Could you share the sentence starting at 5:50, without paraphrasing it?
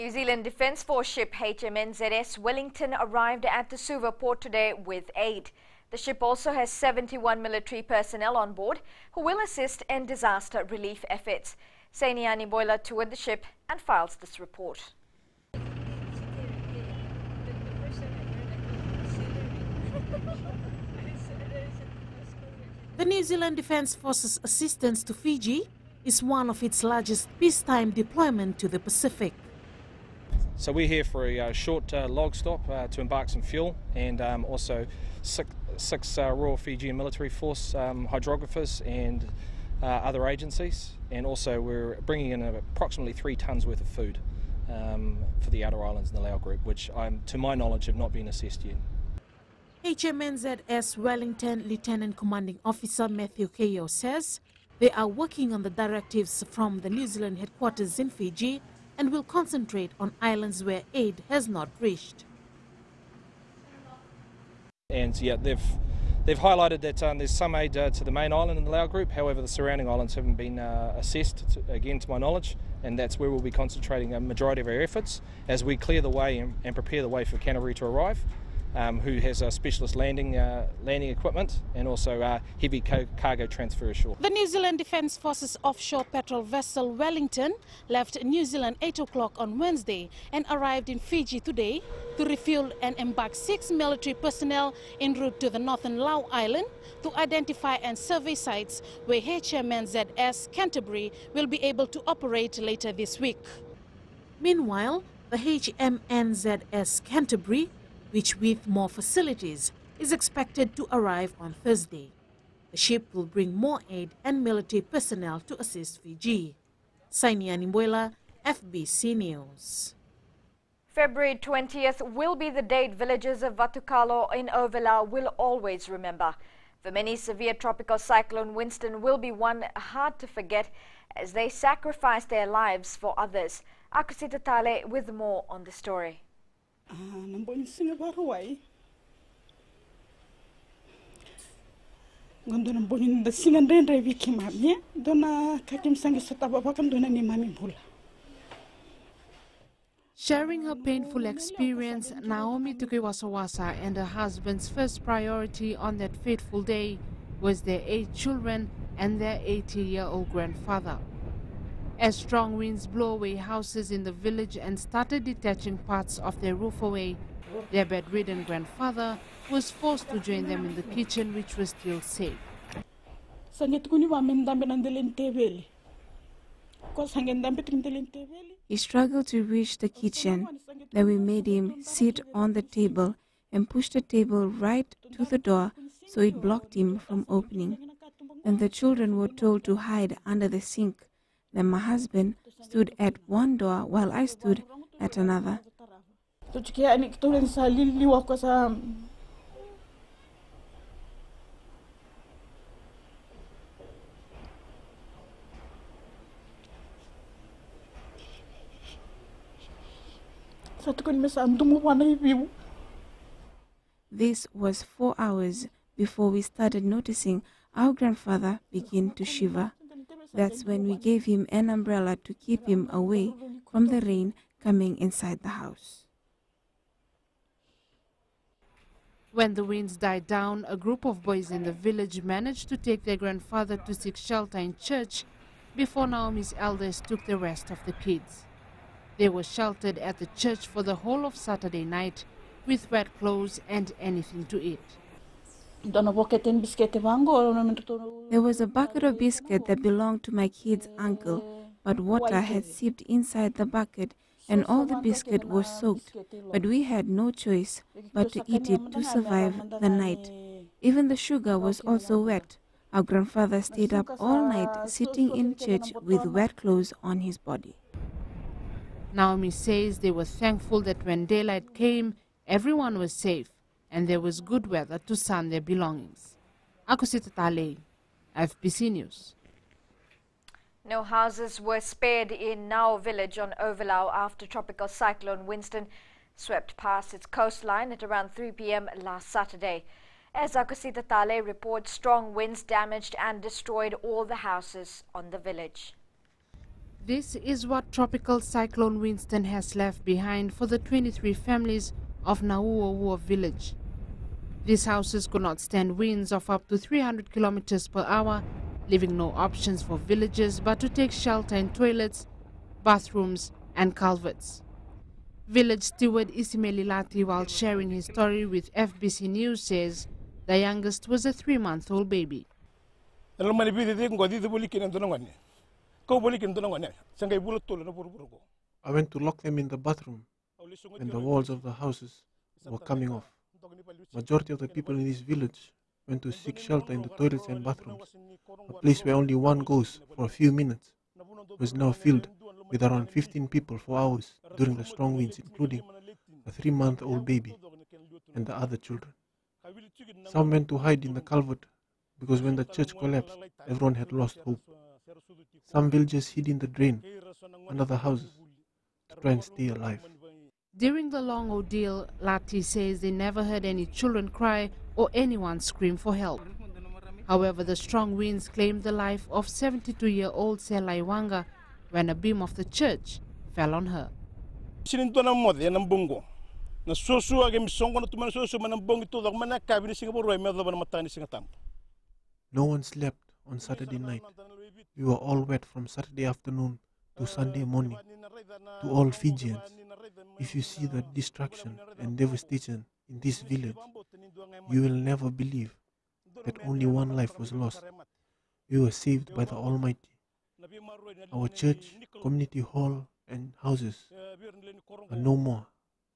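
Some went to hide in the culvert because when the church collapsed, everyone had lost hope.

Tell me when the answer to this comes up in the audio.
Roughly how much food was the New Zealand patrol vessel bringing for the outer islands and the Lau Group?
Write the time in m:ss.
0:43.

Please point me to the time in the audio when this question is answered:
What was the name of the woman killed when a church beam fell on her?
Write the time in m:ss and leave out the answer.
6:10.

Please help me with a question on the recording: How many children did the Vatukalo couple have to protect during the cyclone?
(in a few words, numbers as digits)
8.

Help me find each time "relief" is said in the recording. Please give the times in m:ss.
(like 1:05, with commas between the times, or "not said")
0:10.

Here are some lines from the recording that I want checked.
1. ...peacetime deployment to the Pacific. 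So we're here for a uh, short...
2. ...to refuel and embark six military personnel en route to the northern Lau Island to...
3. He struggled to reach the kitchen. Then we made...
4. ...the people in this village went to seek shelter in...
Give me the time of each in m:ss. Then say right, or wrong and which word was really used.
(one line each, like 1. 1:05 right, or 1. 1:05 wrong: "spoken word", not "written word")
1. 0:27 right
2. 1:32 right
3. 2:58 right
4. 5:34 right.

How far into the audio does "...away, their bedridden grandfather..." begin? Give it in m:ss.
2:46.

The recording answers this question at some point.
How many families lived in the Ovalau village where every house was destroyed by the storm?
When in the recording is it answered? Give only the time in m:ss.
5:00.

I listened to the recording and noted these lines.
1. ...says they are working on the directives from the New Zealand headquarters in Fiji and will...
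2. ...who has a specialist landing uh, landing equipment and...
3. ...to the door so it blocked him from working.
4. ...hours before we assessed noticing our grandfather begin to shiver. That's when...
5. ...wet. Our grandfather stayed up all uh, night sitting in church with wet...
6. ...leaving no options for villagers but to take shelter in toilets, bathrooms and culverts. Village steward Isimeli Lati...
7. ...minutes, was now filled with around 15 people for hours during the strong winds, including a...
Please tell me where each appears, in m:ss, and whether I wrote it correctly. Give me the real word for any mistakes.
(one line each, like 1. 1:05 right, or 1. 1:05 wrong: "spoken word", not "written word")
1. 0:53 right
2. 1:18 right
3. 3:05 wrong: "opening", not "working"
4. 3:35 wrong: "started", not "assessed"
5. 4:22 right
6. 5:08 right
7. 5:40 right.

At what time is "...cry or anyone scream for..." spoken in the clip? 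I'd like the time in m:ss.
6:04.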